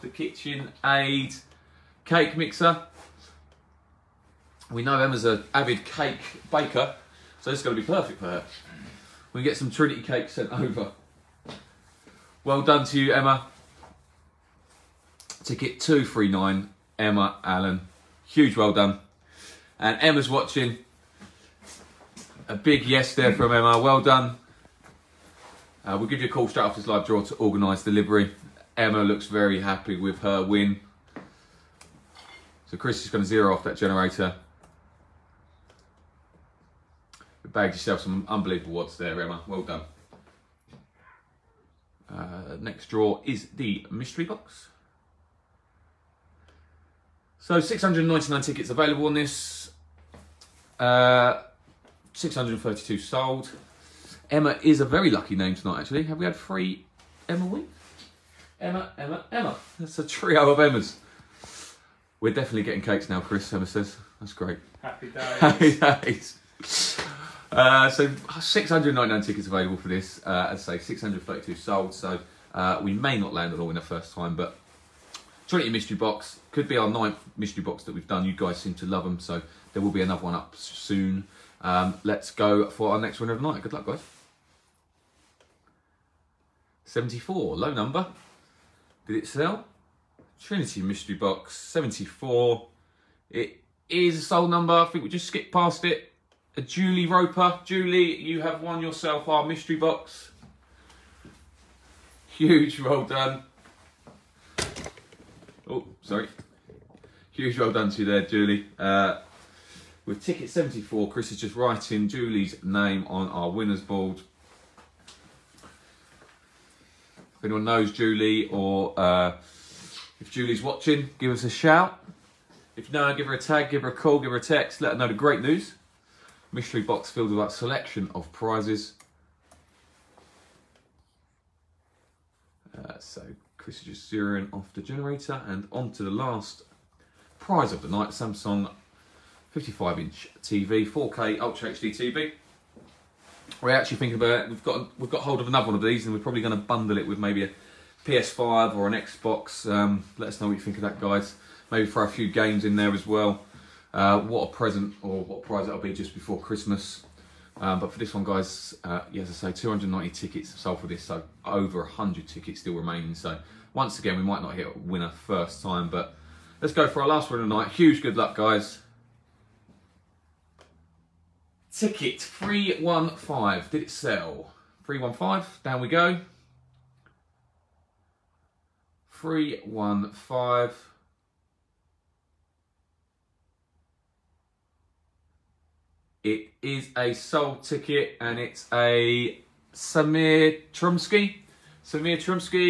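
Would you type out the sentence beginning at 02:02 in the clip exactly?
If no, give her a tag, give her a call, give her a text, let her know the great news.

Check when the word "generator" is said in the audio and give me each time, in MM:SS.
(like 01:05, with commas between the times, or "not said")
00:33, 02:14.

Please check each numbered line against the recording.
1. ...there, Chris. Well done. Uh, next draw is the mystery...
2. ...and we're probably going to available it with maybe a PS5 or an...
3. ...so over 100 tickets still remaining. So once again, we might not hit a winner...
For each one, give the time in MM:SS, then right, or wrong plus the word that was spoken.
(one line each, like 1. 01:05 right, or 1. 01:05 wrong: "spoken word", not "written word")
1. 00:38 wrong: "Emma", not "Chris"
2. 02:26 wrong: "bundle", not "available"
3. 02:41 right.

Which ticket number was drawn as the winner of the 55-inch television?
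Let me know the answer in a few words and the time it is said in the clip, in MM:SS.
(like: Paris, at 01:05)
315, at 02:51.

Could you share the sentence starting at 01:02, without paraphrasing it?
We're definitely getting cakes now, Chris, Emma says.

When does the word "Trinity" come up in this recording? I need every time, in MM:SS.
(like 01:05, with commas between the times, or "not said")
00:09, 01:15, 01:30.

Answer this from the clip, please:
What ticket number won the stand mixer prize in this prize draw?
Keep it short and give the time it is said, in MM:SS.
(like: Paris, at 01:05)
239, at 00:15.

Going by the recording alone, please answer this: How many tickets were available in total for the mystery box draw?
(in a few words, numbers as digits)
699.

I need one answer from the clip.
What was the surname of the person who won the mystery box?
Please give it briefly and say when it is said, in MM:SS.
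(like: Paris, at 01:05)
Roper, at 01:36.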